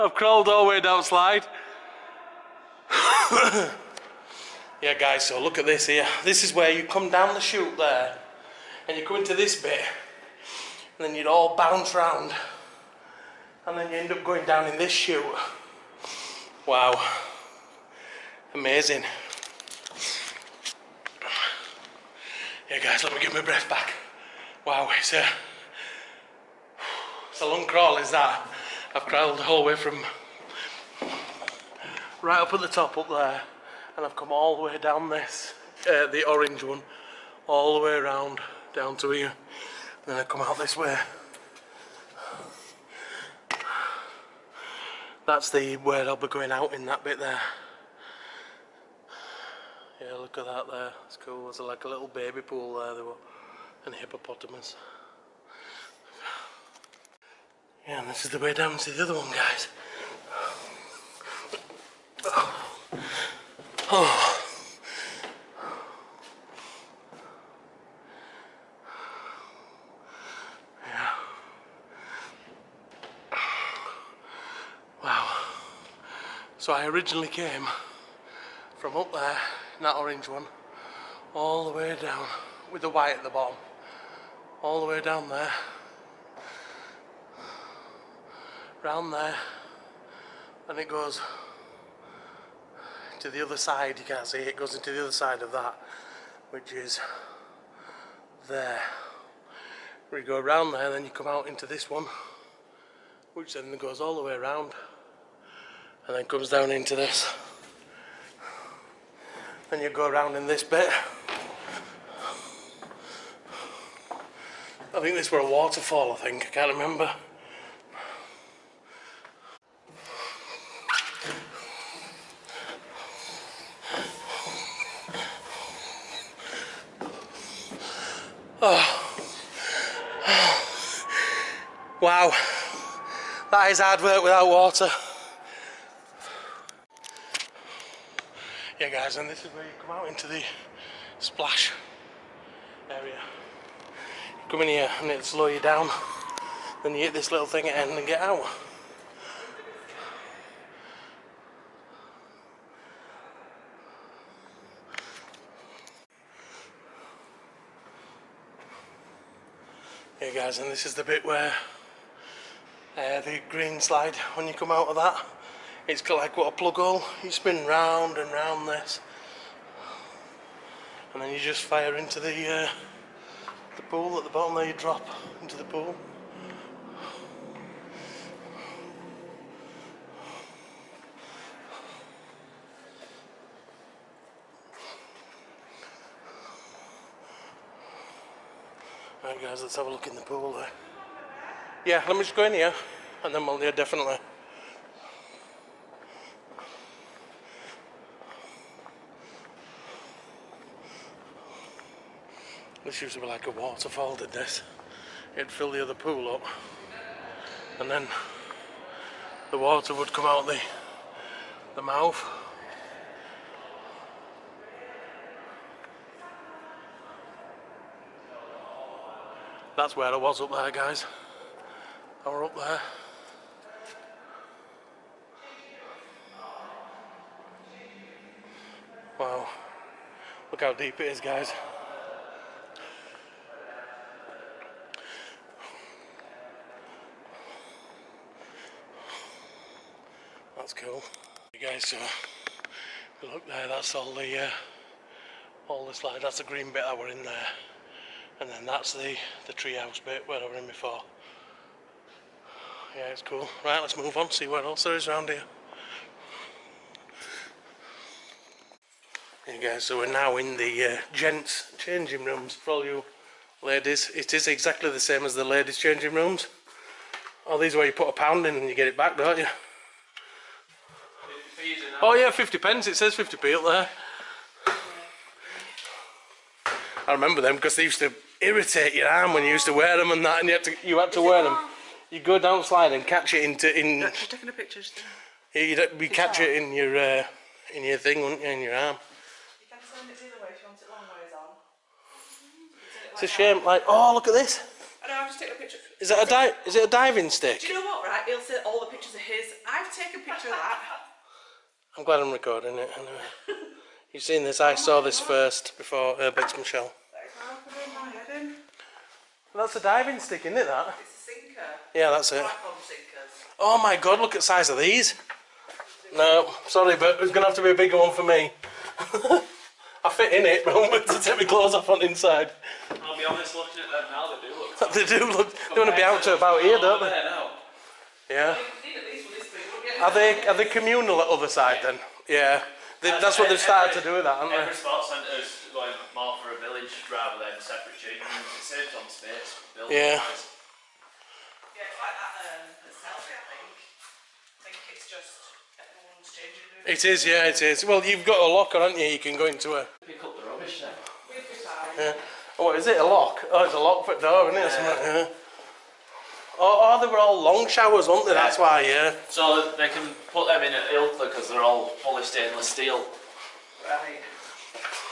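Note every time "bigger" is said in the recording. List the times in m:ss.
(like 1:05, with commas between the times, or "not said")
5:17.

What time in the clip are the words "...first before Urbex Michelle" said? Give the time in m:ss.
5:05.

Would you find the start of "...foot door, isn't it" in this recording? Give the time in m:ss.
5:54.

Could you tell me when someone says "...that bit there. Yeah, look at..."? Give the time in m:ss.
0:46.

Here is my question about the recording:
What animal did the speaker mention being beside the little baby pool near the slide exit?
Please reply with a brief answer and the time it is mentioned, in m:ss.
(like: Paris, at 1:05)
Hippopotamus, at 0:53.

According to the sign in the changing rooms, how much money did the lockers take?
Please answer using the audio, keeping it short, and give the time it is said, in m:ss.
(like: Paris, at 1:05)
50p, at 4:32.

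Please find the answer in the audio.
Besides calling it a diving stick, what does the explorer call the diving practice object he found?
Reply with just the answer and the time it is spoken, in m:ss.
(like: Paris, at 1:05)
A sinker, at 5:11.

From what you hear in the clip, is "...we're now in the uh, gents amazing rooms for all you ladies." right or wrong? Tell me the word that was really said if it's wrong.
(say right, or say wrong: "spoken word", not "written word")
wrong: "changing", not "amazing".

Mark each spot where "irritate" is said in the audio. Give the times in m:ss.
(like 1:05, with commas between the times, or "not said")
4:38.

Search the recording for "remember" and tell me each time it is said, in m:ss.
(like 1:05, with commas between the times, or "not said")
1:56, 4:37.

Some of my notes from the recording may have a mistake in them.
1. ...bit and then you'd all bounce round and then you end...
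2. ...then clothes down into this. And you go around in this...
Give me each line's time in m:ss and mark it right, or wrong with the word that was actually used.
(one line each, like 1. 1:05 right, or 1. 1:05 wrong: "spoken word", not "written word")
1. 0:09 right
2. 1:46 wrong: "comes", not "clothes".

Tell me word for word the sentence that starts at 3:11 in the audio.
Yeah, let me just go in here and then we'll yeah, definitely.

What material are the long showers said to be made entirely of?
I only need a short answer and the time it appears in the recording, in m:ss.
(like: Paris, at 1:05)
Stainless steel, at 6:02.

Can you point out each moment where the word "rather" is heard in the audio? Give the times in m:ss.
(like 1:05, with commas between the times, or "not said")
5:37.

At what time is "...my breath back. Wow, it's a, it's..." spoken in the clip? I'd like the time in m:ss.
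0:23.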